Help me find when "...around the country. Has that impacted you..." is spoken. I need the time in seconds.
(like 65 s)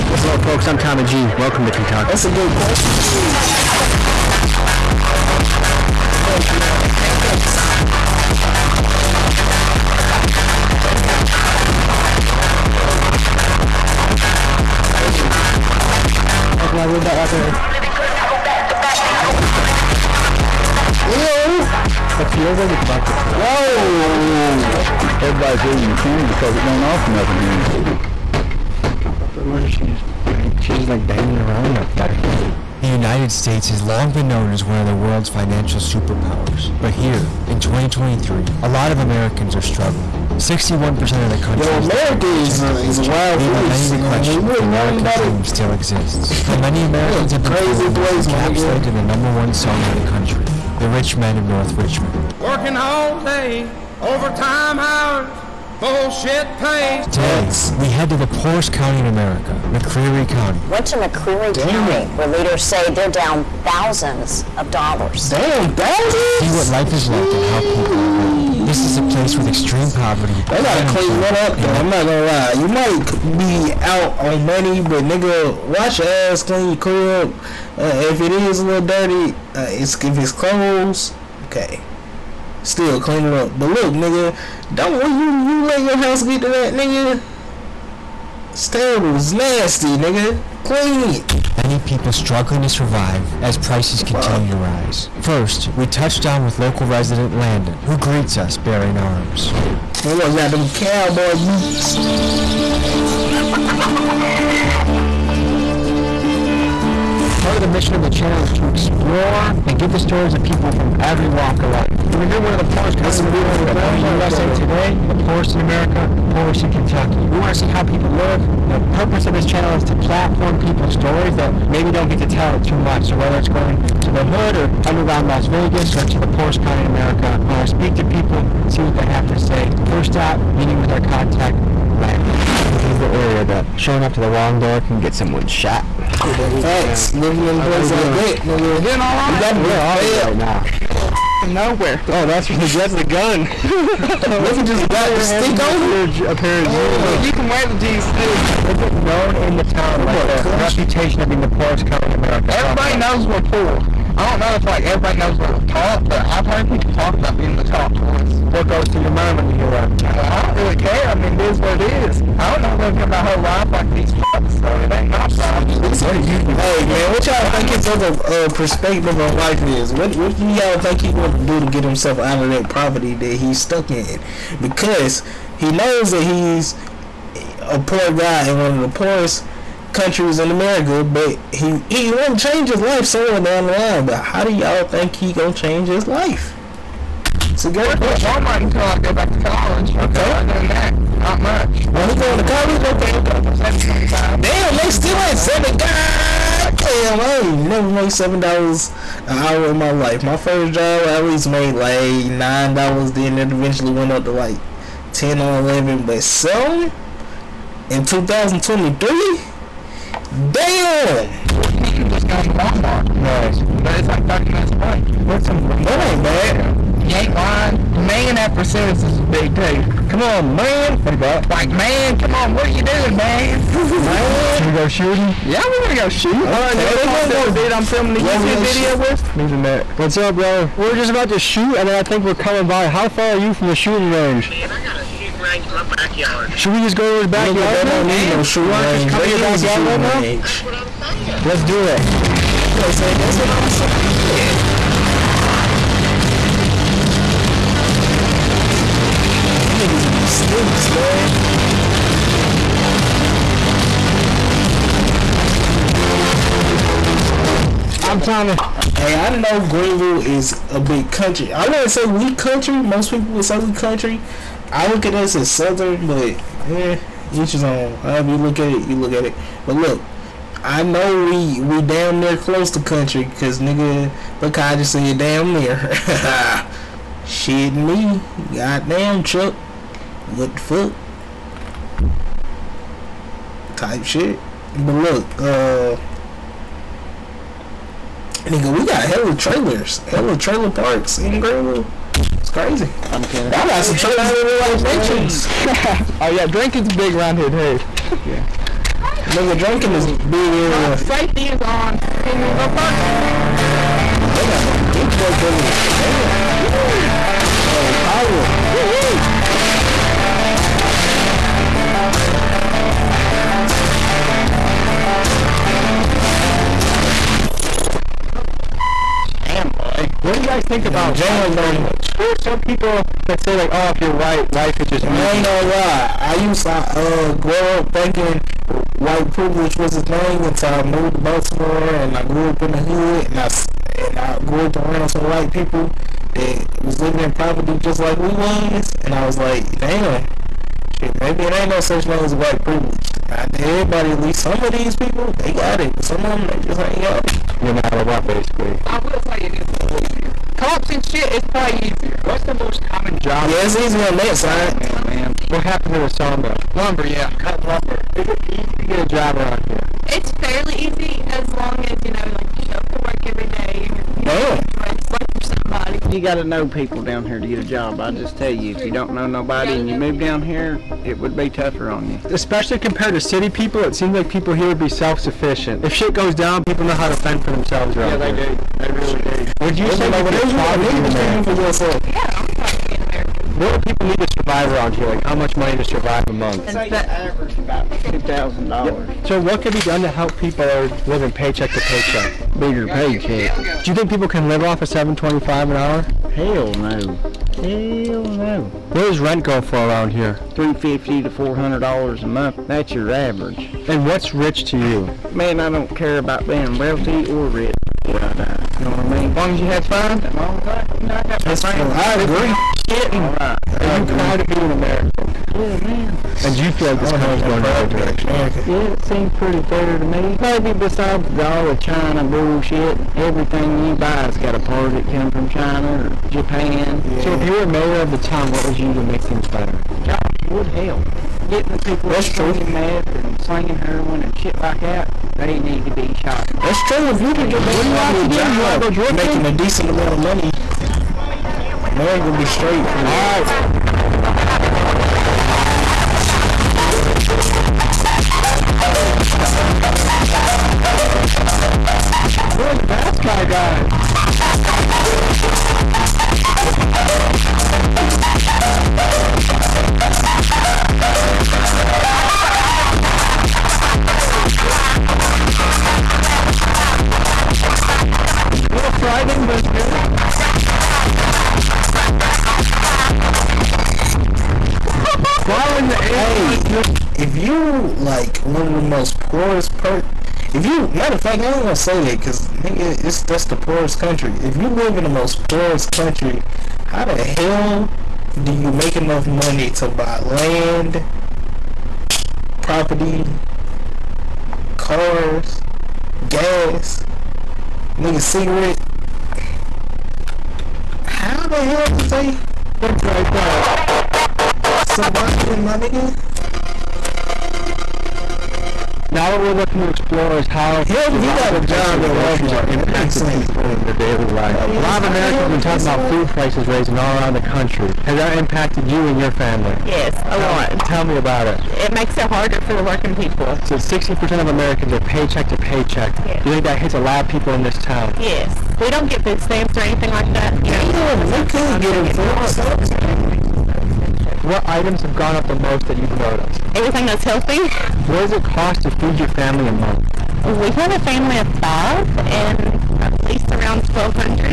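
517 s.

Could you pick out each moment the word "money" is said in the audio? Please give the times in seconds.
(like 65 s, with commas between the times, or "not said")
74 s, 385 s, 440 s, 489 s.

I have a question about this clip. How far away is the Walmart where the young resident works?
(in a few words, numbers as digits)
30 minutes.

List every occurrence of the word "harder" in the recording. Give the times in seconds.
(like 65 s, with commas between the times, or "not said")
522 s.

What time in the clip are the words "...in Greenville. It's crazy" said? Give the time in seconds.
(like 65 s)
291 s.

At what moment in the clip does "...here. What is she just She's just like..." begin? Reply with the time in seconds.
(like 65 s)
27 s.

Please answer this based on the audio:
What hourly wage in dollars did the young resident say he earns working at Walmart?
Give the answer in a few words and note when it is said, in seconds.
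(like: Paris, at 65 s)
14, at 211 s.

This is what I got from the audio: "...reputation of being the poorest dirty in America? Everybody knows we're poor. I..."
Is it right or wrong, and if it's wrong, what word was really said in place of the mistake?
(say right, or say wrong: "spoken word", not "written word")
wrong: "county", not "dirty".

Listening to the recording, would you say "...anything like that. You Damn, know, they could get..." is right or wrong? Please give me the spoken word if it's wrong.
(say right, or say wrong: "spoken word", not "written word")
right.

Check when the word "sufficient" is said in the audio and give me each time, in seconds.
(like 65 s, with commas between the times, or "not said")
374 s.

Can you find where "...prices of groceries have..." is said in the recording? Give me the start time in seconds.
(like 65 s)
511 s.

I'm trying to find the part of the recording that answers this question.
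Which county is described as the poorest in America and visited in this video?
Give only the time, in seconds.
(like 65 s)
59 s.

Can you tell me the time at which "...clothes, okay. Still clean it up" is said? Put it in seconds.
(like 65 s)
80 s.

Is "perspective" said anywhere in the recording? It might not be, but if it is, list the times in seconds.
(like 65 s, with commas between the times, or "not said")
168 s.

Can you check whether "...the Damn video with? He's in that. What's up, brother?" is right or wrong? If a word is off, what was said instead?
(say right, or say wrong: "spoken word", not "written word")
wrong: "YouTube", not "Damn".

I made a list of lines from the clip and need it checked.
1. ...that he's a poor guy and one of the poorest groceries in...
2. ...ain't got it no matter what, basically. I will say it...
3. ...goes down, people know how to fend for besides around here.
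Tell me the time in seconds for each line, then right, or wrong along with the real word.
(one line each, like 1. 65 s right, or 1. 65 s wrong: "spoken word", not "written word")
1. 176 s wrong: "countries", not "groceries"
2. 346 s right
3. 376 s wrong: "themselves", not "besides".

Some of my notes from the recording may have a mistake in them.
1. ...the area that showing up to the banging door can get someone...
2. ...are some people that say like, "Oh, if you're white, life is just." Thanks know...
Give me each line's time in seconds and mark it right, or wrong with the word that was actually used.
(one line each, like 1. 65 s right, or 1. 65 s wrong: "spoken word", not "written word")
1. 132 s wrong: "wrong", not "banging"
2. 322 s wrong: "You", not "Thanks".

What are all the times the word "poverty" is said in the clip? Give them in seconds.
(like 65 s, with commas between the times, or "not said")
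69 s, 172 s, 337 s.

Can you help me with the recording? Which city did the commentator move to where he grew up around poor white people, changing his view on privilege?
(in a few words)
Baltimore.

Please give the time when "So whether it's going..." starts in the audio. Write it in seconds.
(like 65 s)
123 s.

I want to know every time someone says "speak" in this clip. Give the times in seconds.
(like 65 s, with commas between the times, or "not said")
127 s.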